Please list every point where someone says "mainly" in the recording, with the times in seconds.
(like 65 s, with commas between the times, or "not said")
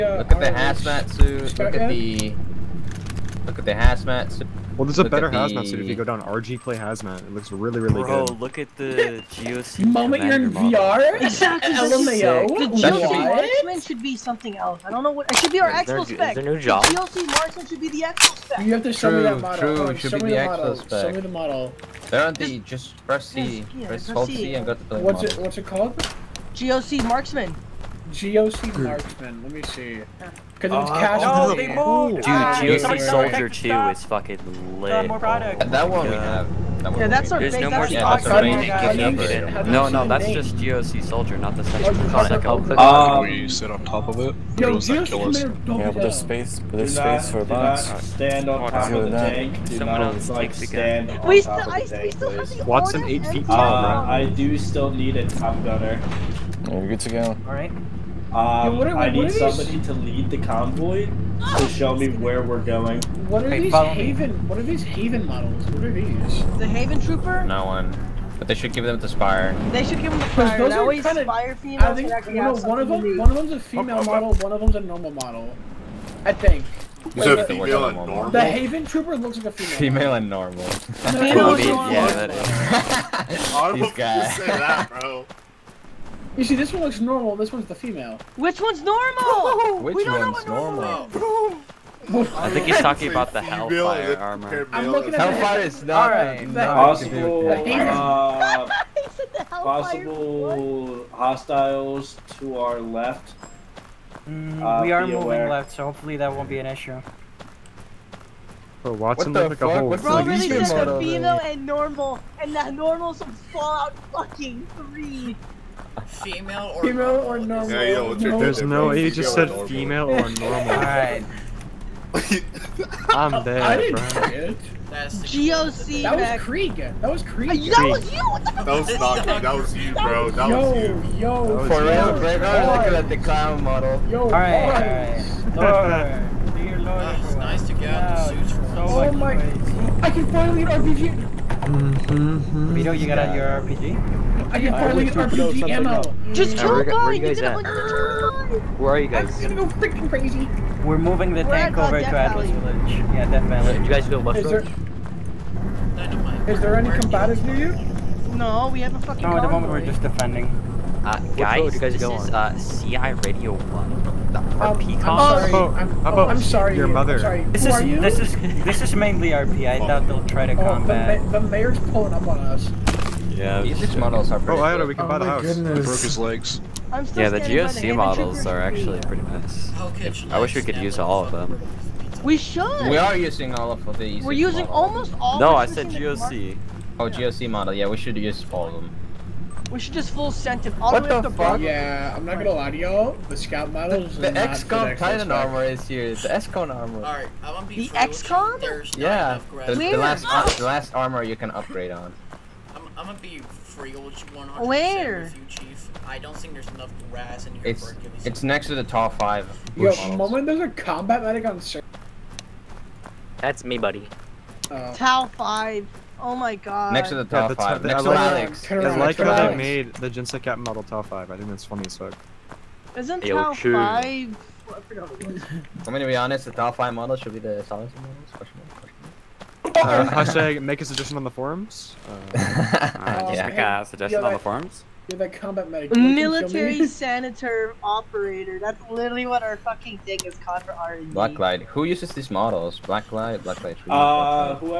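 168 s.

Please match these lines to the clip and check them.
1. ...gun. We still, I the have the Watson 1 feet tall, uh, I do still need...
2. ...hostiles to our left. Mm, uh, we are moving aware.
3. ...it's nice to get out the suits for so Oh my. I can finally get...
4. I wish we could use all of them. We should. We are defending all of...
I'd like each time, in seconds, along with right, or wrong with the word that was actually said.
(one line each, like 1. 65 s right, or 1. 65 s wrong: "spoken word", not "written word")
1. 50 s wrong: "8", not "1"
2. 101 s right
3. 137 s right
4. 180 s wrong: "using", not "defending".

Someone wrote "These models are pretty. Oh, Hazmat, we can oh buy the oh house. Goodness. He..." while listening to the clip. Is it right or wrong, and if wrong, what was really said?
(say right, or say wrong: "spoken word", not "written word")
wrong: "Iota", not "Hazmat".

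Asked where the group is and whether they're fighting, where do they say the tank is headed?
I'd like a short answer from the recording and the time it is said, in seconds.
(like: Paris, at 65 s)
Atlas Village, at 152 s.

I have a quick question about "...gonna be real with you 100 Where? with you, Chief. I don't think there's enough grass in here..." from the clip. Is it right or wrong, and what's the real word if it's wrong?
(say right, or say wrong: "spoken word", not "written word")
right.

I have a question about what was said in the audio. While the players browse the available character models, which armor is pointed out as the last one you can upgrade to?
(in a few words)
XCOM Titan armor.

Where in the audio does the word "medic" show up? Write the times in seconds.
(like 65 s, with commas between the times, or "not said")
211 s, 235 s.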